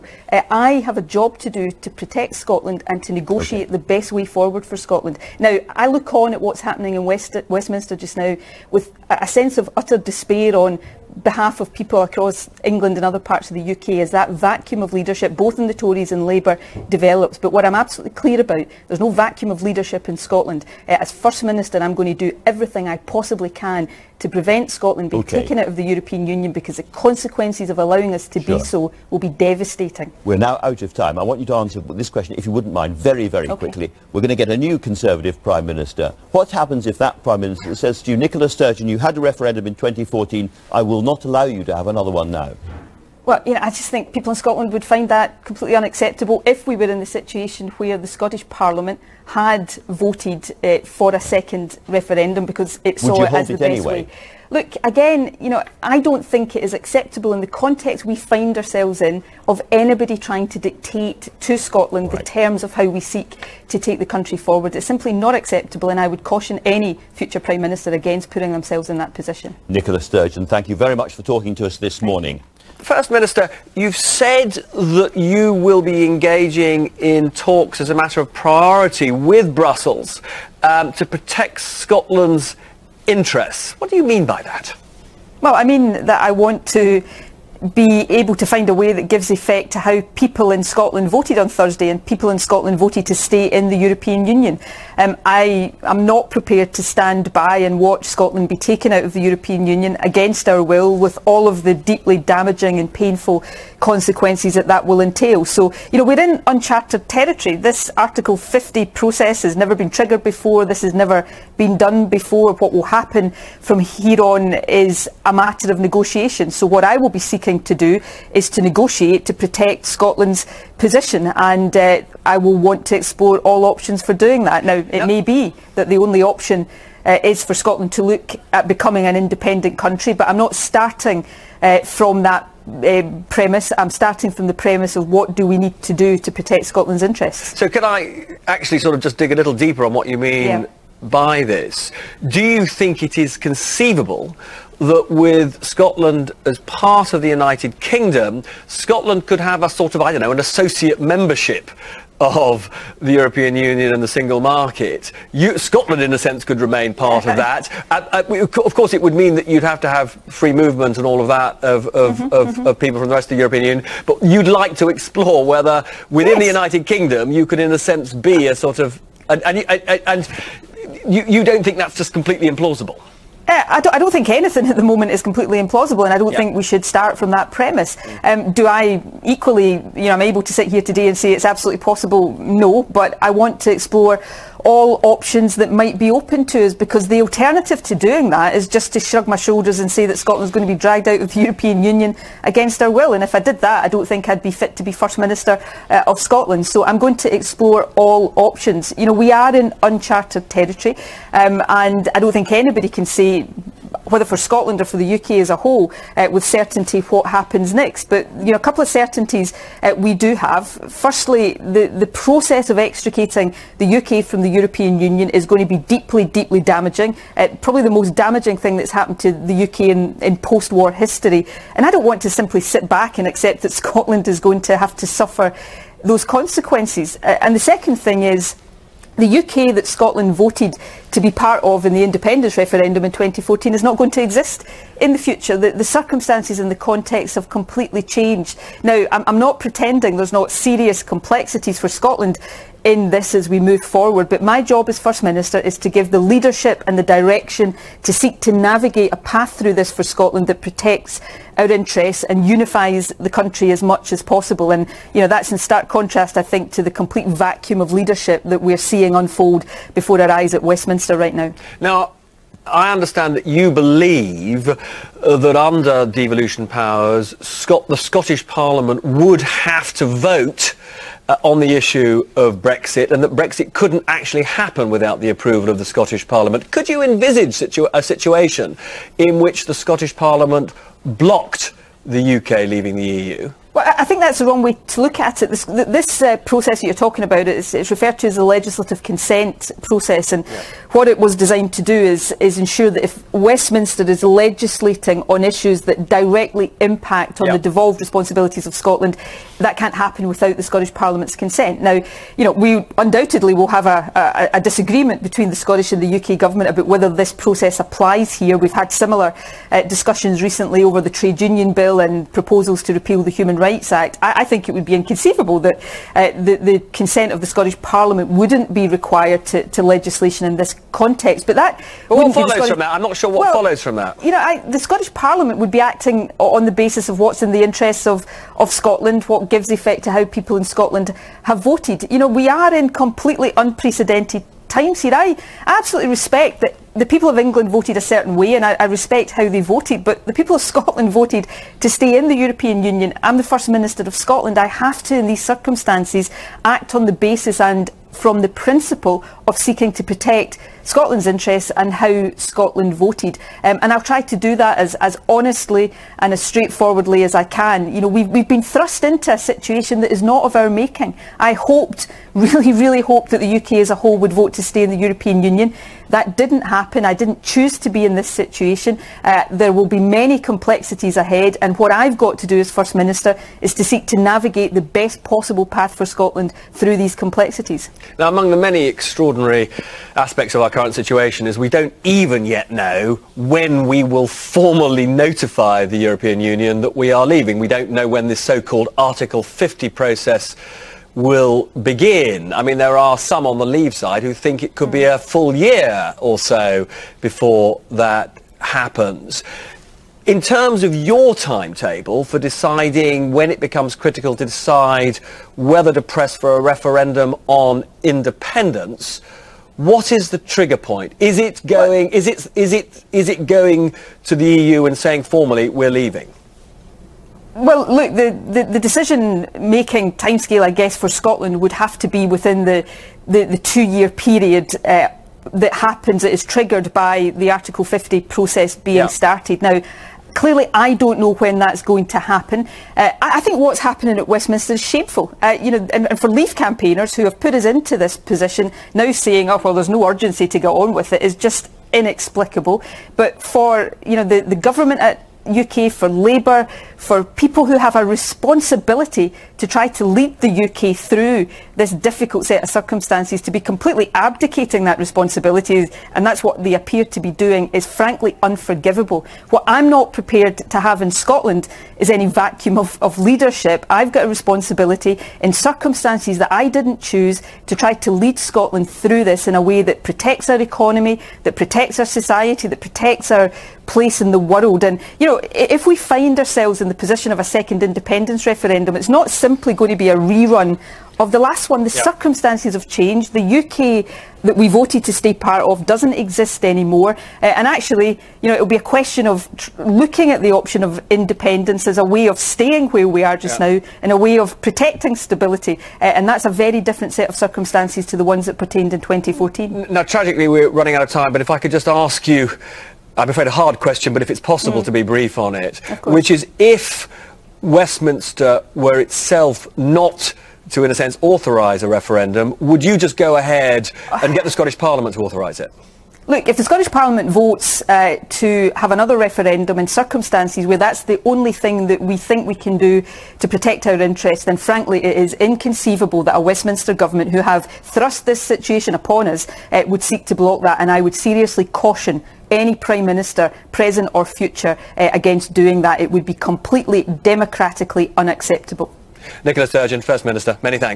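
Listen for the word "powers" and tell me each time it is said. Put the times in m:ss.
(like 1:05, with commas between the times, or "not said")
4:26.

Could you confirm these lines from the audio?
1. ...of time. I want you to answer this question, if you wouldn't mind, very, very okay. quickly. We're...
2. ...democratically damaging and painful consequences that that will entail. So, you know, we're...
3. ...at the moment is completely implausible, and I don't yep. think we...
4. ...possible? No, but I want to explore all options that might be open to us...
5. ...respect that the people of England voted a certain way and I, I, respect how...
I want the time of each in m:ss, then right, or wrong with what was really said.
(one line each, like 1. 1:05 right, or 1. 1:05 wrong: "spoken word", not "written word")
1. 0:30 right
2. 1:41 wrong: "deeply", not "democratically"
3. 2:54 right
4. 3:01 right
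5. 5:36 right.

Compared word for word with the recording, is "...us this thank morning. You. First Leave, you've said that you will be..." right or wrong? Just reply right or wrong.
wrong.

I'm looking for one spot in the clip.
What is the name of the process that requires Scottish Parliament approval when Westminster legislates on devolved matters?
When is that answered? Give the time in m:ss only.
4:48.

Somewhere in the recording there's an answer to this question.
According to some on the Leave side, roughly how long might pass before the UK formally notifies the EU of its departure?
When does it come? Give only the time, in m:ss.
6:35.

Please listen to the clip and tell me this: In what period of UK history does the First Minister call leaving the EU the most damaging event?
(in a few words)
Post-war history.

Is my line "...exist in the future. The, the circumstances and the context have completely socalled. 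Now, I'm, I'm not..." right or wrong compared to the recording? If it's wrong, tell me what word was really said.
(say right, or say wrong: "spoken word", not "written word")
wrong: "changed", not "socalled".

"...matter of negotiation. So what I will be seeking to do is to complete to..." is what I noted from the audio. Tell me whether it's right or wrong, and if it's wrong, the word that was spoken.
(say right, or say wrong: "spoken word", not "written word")
wrong: "negotiate", not "complete".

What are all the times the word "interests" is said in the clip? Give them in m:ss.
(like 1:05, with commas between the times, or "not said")
1:23, 2:17, 4:11, 5:27, 5:51, 8:43.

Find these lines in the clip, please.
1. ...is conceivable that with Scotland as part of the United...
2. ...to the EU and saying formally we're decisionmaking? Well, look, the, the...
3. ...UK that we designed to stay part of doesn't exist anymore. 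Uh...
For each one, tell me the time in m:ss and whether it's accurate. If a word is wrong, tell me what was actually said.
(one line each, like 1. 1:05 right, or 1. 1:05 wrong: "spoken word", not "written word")
1. 2:23 right
2. 6:54 wrong: "leaving", not "decisionmaking"
3. 8:03 wrong: "voted", not "designed".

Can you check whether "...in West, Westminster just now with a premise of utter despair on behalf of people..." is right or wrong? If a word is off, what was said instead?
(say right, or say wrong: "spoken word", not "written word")
wrong: "sense", not "premise".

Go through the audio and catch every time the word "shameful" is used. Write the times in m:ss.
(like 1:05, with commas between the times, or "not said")
7:14.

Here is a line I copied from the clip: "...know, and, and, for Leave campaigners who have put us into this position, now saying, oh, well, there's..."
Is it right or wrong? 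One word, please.
right.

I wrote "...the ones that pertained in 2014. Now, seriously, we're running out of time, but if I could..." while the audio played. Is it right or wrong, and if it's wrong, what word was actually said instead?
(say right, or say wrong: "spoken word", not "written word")
wrong: "tragically", not "seriously".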